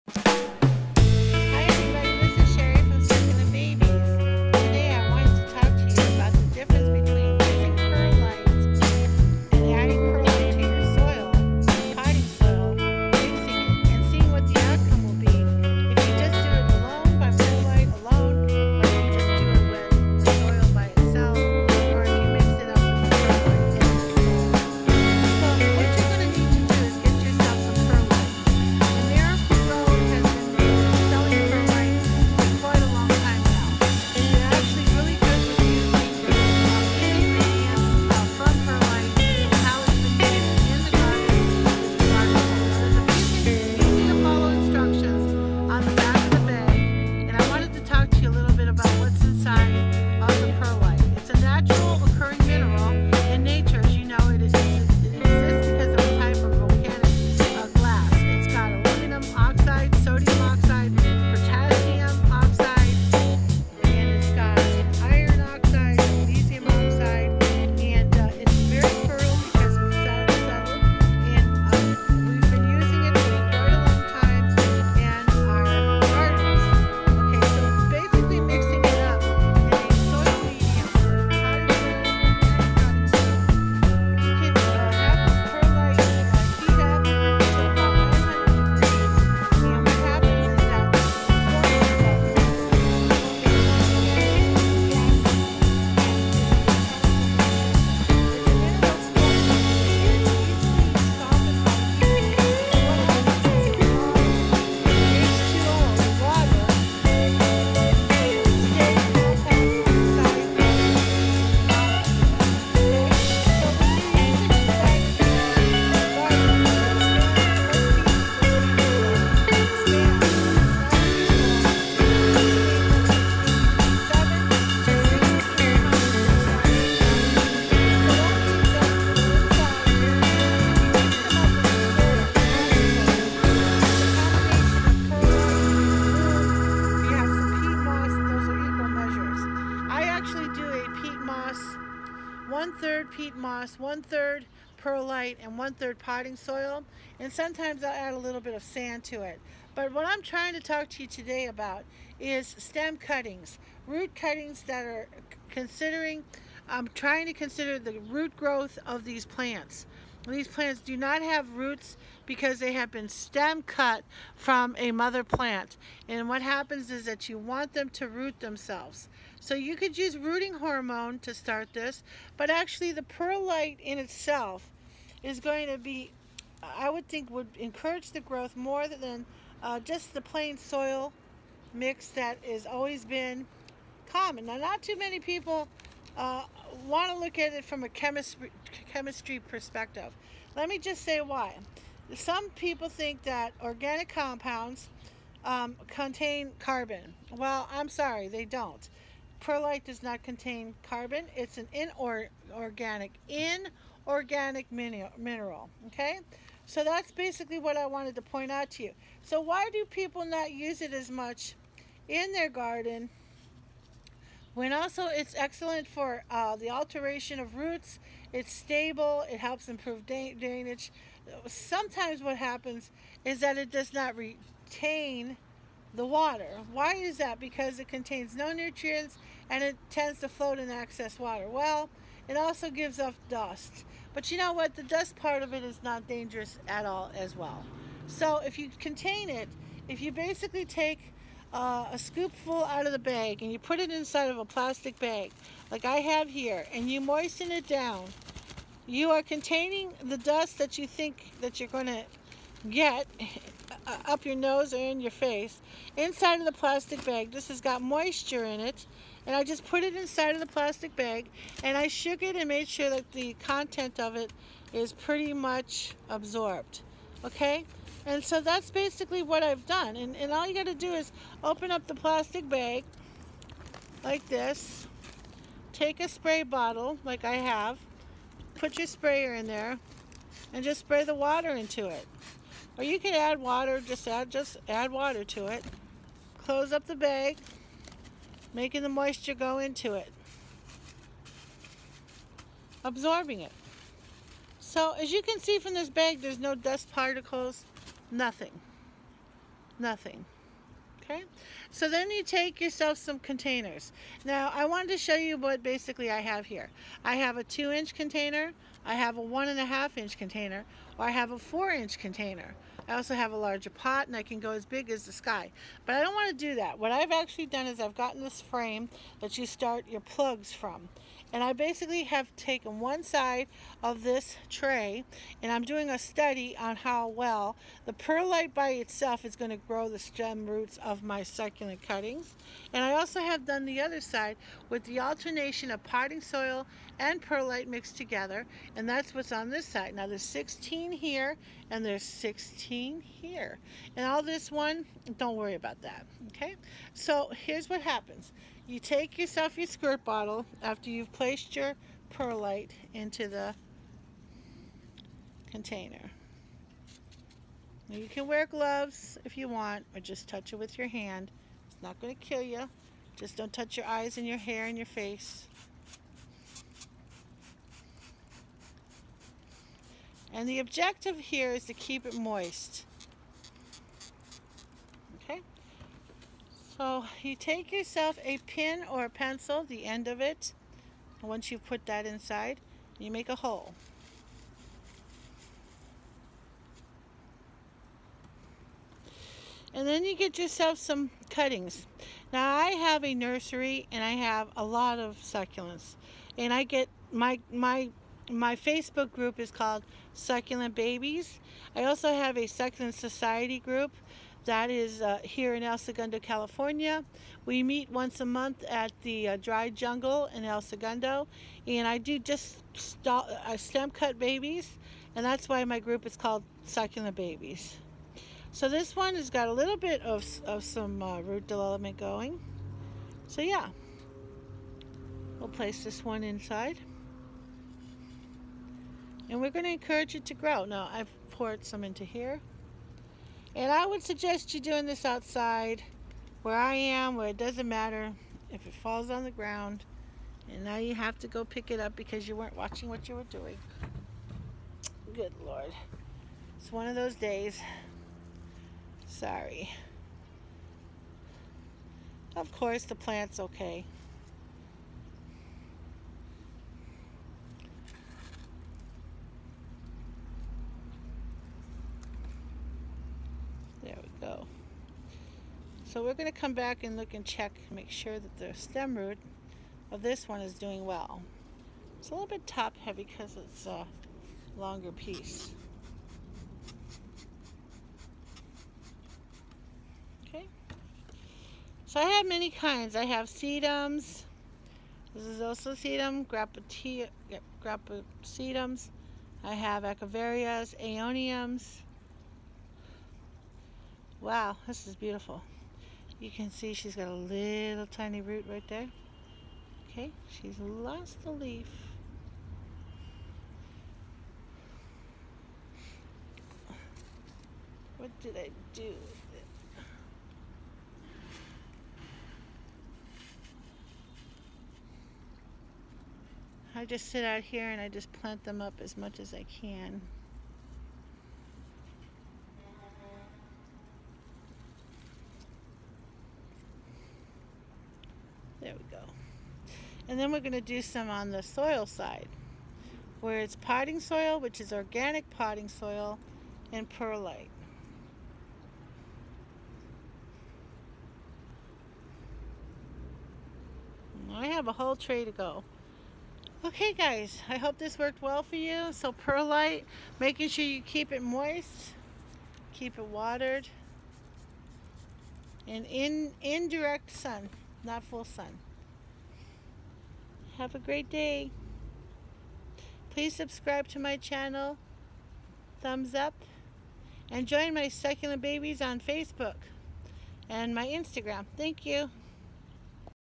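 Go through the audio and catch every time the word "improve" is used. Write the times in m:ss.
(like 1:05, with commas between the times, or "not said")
3:39.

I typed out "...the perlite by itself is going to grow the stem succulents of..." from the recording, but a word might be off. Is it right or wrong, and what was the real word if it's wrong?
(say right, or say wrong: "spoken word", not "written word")
wrong: "roots", not "succulents".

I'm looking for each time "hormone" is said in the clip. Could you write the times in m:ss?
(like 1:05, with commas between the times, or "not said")
2:50.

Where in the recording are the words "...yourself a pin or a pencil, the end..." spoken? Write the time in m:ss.
6:17.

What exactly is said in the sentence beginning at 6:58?
So this one has got a little bit of, of some uh, root development going.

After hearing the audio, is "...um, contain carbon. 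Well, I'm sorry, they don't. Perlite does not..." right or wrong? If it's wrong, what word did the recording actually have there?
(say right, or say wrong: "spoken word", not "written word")
right.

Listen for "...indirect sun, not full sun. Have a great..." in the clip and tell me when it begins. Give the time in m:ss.
9:16.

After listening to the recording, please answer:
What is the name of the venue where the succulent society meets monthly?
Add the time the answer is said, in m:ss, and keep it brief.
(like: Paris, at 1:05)
Dry Jungle, at 6:49.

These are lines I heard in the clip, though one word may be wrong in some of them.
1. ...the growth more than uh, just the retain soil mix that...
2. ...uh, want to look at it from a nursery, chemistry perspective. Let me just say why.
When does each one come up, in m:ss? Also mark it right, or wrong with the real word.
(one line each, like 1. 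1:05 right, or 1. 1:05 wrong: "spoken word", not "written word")
1. 2:58 wrong: "plain", not "retain"
2. 3:06 wrong: "chemistry", not "nursery".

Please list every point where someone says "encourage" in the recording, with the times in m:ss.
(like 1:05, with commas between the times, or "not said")
2:57, 7:09.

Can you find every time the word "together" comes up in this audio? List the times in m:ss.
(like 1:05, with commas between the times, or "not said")
5:37.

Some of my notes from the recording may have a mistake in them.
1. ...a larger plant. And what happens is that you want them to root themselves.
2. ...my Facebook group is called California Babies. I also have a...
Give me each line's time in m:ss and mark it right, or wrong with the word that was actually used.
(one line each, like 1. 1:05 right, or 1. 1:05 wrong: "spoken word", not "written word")
1. 2:44 wrong: "mother", not "larger"
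2. 6:38 wrong: "Succulent", not "California".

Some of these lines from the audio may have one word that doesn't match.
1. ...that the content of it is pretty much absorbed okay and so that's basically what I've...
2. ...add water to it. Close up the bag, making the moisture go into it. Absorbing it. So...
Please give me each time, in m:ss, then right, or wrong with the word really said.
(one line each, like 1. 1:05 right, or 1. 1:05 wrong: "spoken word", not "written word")
1. 4:22 right
2. 4:44 right.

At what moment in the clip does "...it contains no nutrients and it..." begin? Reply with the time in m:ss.
3:47.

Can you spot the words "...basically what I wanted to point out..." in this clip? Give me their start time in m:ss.
3:27.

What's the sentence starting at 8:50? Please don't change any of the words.
And then we're going to do some on the soil side, where it's potting soil, which is organic potting soil, and perlite.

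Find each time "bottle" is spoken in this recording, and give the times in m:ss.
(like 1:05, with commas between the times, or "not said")
4:36, 5:50.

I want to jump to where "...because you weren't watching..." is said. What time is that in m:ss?
7:21.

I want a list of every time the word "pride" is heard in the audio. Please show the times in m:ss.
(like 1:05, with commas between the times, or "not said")
not said.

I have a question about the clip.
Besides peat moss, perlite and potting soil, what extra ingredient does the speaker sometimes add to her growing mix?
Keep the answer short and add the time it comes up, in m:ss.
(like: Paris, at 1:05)
Sand, at 2:28.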